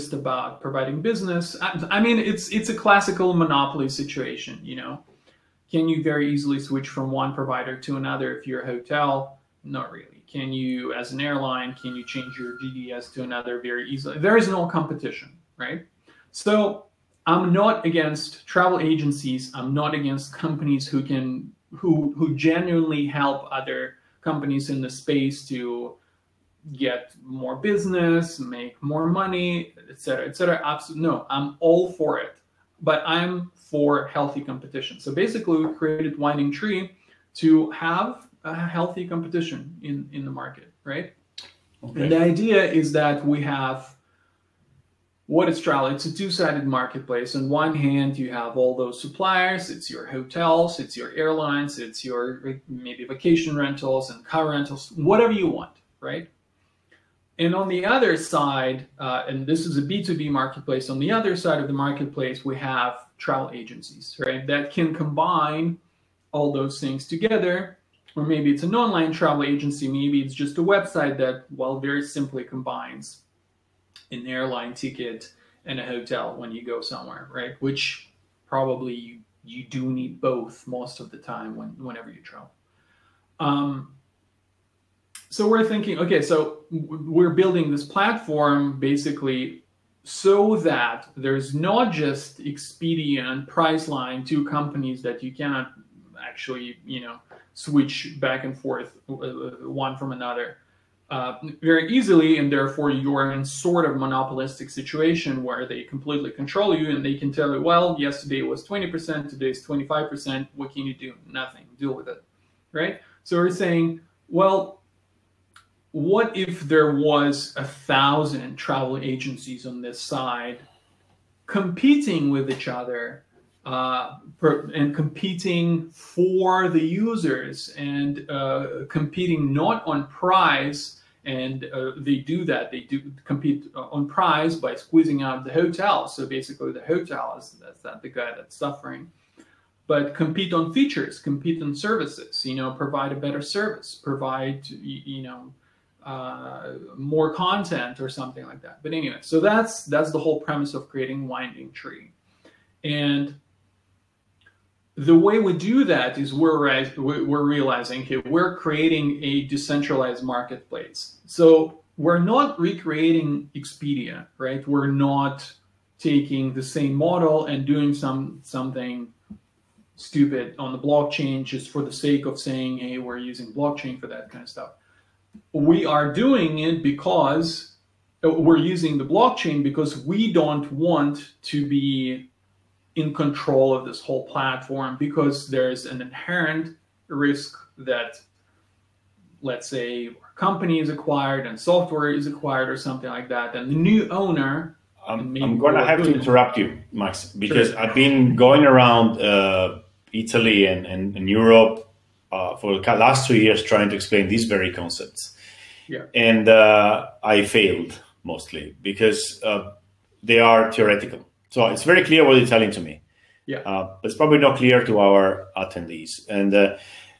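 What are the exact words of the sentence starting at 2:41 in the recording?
So we're not recreating Expedia, right?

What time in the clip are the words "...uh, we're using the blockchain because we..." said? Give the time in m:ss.
2:58.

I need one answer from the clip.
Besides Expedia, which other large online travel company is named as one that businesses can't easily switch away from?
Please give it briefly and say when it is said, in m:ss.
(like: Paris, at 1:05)
Priceline, at 1:33.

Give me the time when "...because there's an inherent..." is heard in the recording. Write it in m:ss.
3:04.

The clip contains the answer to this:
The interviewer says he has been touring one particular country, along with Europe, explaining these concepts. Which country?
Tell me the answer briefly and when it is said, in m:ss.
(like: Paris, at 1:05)
Italy, at 3:20.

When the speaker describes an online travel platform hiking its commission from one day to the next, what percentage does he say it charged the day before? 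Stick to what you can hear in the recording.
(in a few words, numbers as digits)
20%.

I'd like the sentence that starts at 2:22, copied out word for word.
You know, provide a better service, provide you know uh, more content or something like that.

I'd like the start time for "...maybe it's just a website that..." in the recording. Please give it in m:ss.
1:09.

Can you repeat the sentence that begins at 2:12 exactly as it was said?
They do compete uh, on price by squeezing out the hotel.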